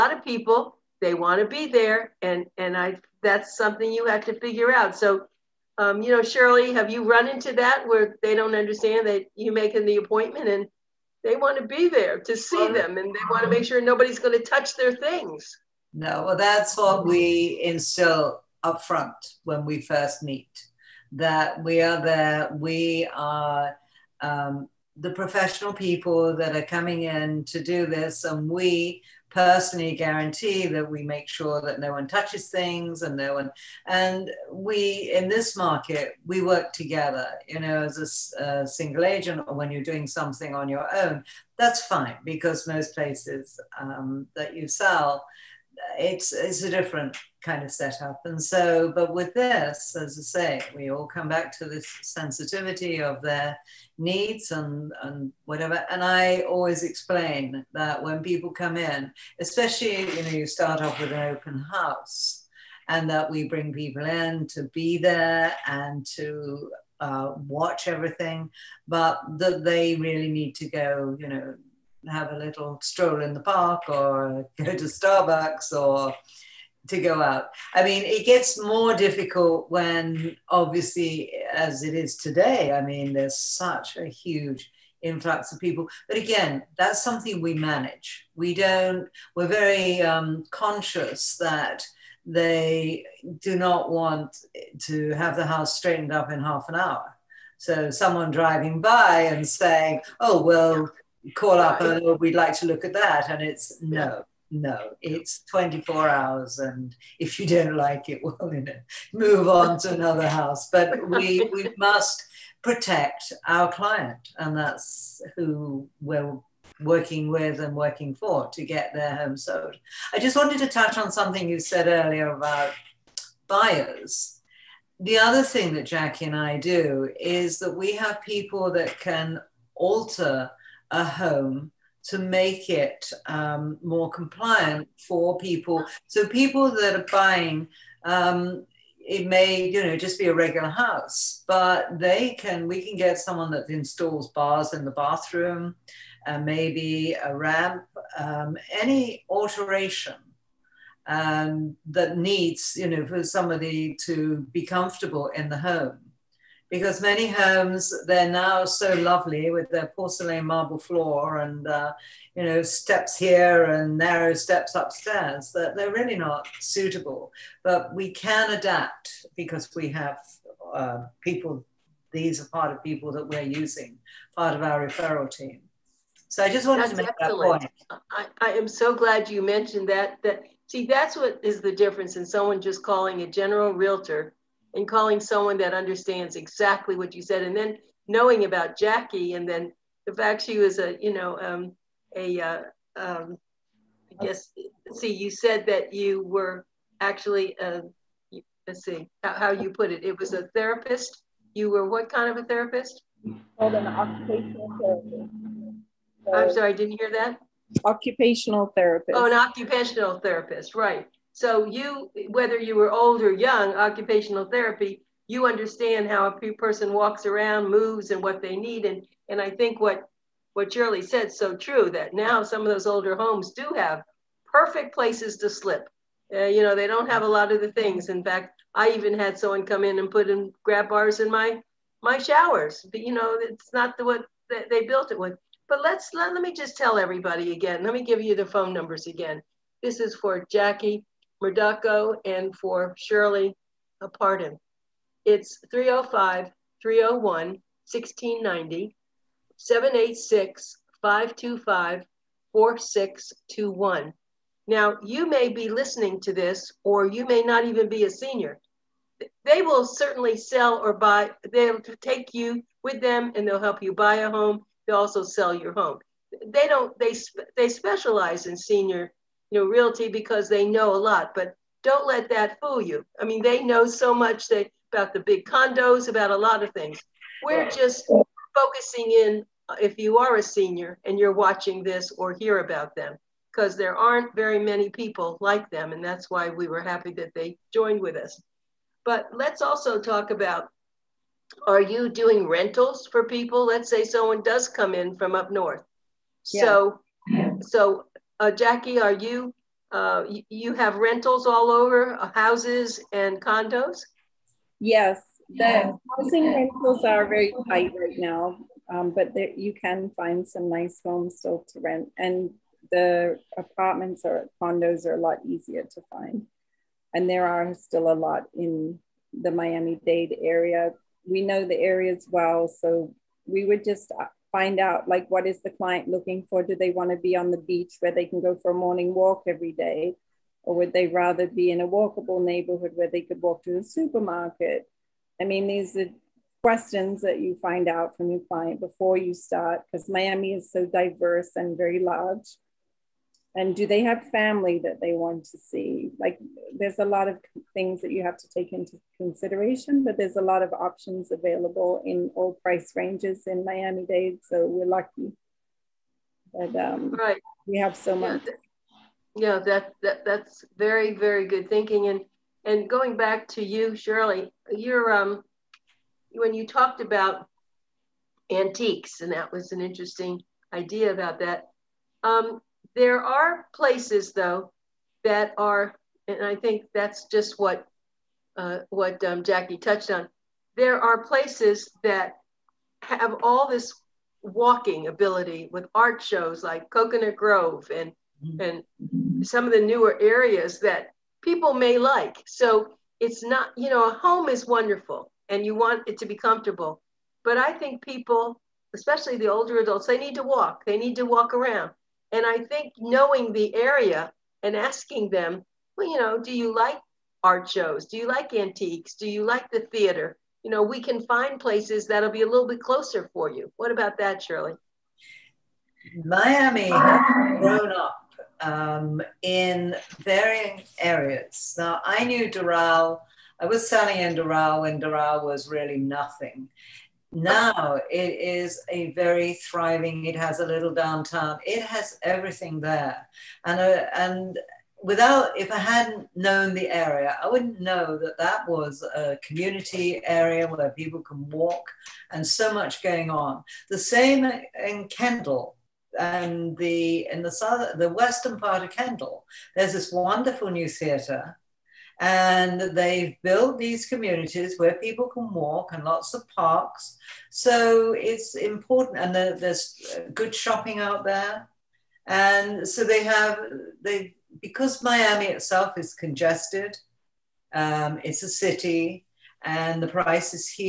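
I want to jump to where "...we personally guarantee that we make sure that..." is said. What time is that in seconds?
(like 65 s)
28 s.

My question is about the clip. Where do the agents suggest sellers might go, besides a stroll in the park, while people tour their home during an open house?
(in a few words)
Starbucks.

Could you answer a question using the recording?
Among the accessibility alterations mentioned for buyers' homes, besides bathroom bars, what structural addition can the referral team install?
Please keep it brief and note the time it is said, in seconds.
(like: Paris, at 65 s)
a ramp, at 147 s.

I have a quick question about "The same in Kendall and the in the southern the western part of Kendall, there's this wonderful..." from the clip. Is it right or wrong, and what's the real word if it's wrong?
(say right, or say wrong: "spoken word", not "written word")
right.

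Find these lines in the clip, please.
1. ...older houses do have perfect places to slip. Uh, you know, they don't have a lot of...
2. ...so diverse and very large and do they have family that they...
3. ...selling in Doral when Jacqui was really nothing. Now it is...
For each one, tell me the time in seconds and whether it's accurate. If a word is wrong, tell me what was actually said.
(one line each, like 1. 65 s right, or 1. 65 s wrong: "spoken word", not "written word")
1. 222 s wrong: "homes", not "houses"
2. 340 s right
3. 423 s wrong: "Doral", not "Jacqui".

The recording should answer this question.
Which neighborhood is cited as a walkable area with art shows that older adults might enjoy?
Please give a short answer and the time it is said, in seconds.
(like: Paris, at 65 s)
Coconut Grove, at 386 s.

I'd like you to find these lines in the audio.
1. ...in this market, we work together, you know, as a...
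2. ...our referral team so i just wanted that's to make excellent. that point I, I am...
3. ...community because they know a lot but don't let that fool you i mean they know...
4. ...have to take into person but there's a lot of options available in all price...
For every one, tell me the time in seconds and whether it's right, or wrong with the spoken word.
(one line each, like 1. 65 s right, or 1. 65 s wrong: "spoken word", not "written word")
1. 35 s right
2. 174 s right
3. 269 s wrong: "realty", not "community"
4. 348 s wrong: "consideration", not "person".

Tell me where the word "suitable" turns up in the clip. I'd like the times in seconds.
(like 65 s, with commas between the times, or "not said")
166 s.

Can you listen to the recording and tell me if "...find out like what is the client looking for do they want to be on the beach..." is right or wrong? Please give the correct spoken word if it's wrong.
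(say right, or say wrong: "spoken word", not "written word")
right.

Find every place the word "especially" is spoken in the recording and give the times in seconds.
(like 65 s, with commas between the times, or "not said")
59 s, 398 s.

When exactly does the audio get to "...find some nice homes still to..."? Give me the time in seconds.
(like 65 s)
310 s.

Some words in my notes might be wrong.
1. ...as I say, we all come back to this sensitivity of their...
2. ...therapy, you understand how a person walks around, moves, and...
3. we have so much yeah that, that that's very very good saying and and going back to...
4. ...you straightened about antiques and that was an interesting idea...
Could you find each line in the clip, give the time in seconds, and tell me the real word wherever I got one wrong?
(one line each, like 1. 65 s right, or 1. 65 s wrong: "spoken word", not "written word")
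1. 49 s right
2. 214 s right
3. 357 s wrong: "thinking", not "saying"
4. 366 s wrong: "talked", not "straightened".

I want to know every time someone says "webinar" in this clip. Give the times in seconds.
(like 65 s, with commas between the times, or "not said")
not said.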